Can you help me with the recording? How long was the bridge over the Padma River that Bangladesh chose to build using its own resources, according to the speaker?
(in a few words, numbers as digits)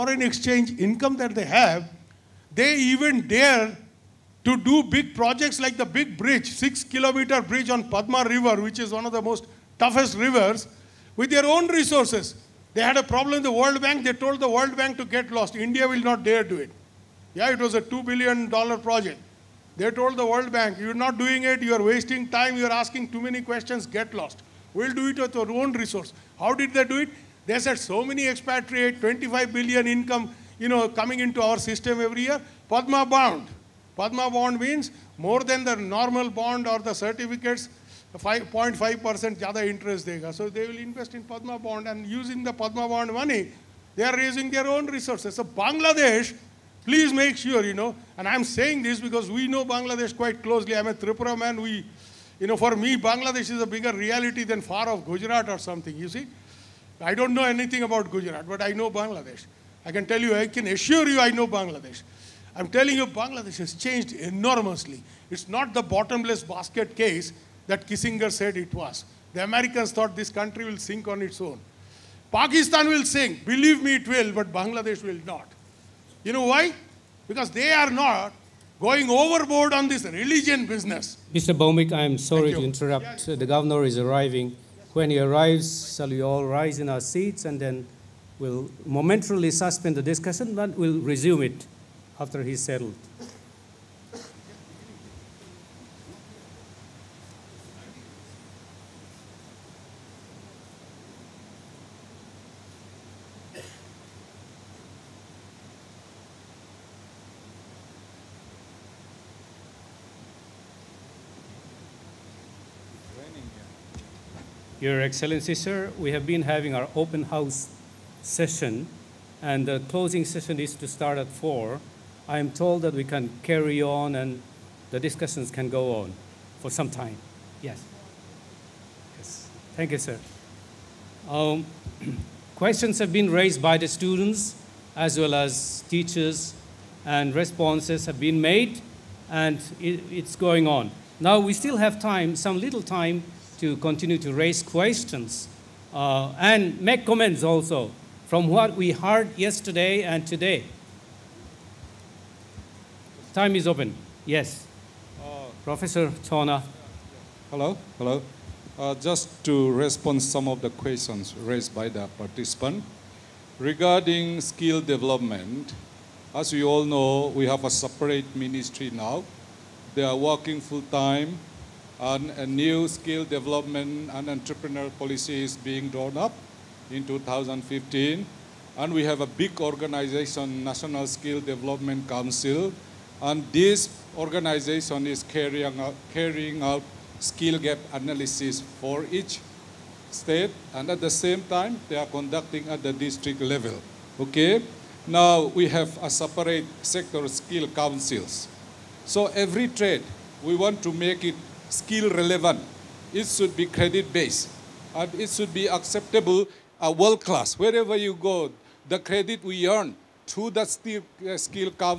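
6 kilometers.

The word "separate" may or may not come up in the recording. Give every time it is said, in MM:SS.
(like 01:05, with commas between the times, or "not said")
02:47, 03:16.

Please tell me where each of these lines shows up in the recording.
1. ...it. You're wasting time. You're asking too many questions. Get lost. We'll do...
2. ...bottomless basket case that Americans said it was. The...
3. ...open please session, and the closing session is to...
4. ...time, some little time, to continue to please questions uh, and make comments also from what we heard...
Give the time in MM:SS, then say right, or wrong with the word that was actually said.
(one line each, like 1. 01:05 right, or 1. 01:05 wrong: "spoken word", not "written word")
1. 00:21 right
2. 01:05 wrong: "Kissinger", not "Americans"
3. 01:56 wrong: "house", not "please"
4. 02:22 wrong: "raise", not "please".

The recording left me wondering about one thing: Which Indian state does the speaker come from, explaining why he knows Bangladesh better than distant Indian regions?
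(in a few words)
Tripura.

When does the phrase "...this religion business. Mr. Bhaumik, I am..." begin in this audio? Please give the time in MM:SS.
01:19.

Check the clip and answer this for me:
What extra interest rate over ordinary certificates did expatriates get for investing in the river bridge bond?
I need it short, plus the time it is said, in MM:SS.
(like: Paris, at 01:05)
5.5%, at 00:38.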